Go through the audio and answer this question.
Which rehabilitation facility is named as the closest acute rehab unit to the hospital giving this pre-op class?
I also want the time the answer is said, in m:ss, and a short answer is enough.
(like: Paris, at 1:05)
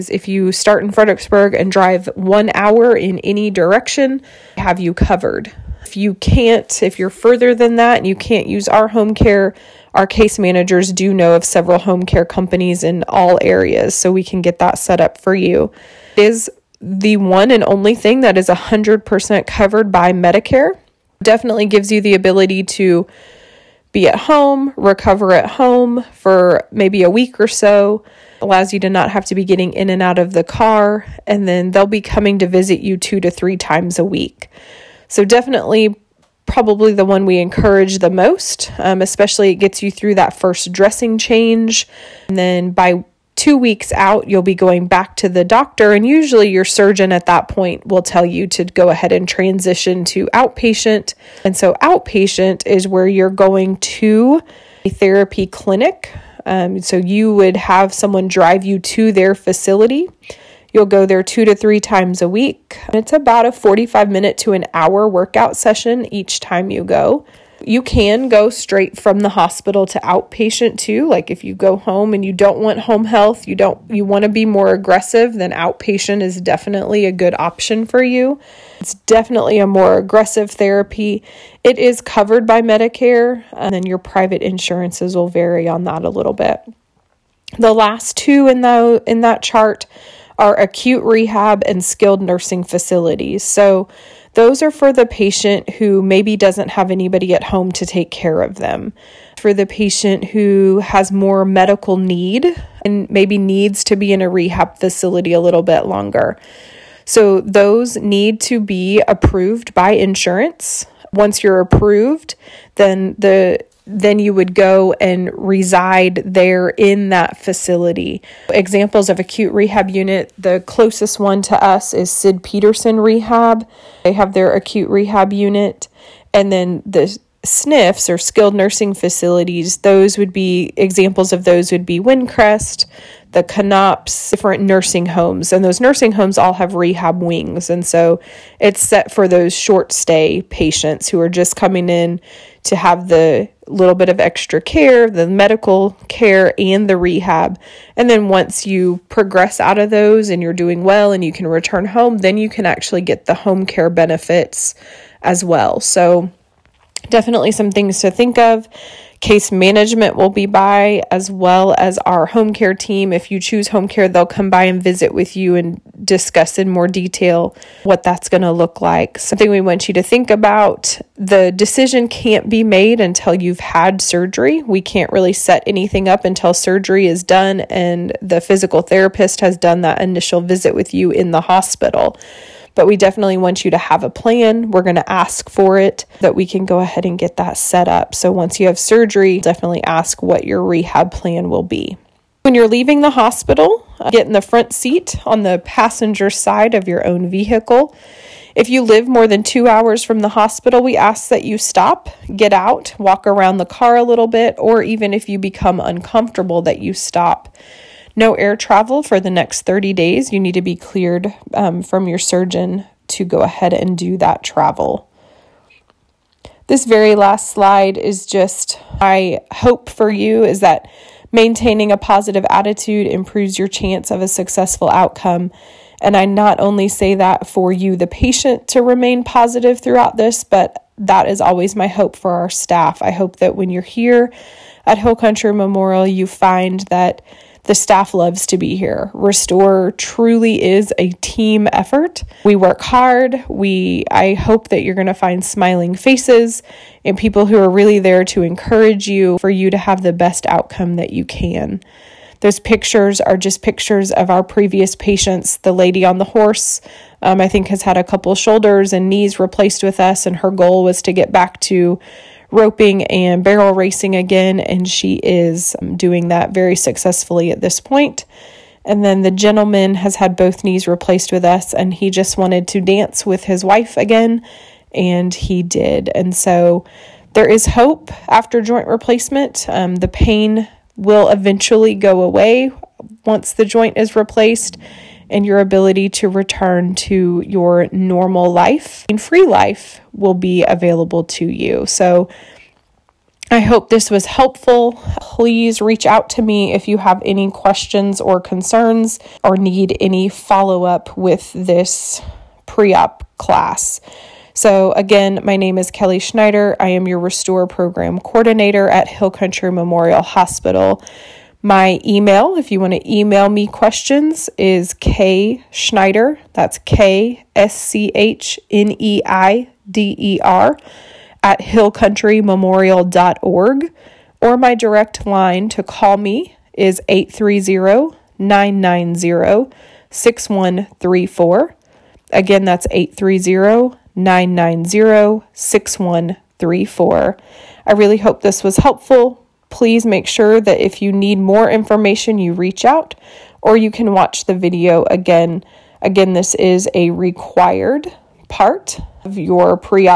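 Sid Peterson Rehab, at 2:02.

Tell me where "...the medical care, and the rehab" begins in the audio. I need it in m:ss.
2:25.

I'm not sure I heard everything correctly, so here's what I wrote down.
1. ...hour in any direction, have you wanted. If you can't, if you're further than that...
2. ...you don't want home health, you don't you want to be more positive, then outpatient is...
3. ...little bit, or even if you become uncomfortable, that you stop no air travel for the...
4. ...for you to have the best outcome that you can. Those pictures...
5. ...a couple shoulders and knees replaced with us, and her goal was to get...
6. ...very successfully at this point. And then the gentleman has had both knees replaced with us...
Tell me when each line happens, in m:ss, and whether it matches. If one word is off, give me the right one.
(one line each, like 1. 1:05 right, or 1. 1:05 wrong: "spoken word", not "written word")
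1. 0:02 wrong: "covered", not "wanted"
2. 1:12 wrong: "aggressive", not "positive"
3. 3:24 right
4. 4:09 right
5. 4:17 right
6. 4:26 right.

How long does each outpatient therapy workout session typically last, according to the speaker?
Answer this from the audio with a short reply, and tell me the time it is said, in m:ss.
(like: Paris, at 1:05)
45 minutes to an hour, at 1:03.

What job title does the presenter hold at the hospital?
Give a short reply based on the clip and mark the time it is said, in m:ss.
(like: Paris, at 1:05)
Restore Program Coordinator, at 5:07.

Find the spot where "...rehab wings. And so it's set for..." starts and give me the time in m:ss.
2:16.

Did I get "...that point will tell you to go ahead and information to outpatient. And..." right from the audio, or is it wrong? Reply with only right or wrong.
wrong.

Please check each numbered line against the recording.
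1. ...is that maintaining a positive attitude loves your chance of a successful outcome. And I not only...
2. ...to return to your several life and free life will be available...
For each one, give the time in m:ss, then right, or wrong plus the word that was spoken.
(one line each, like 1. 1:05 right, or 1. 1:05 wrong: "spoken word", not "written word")
1. 3:40 wrong: "improves", not "loves"
2. 4:46 wrong: "normal", not "several".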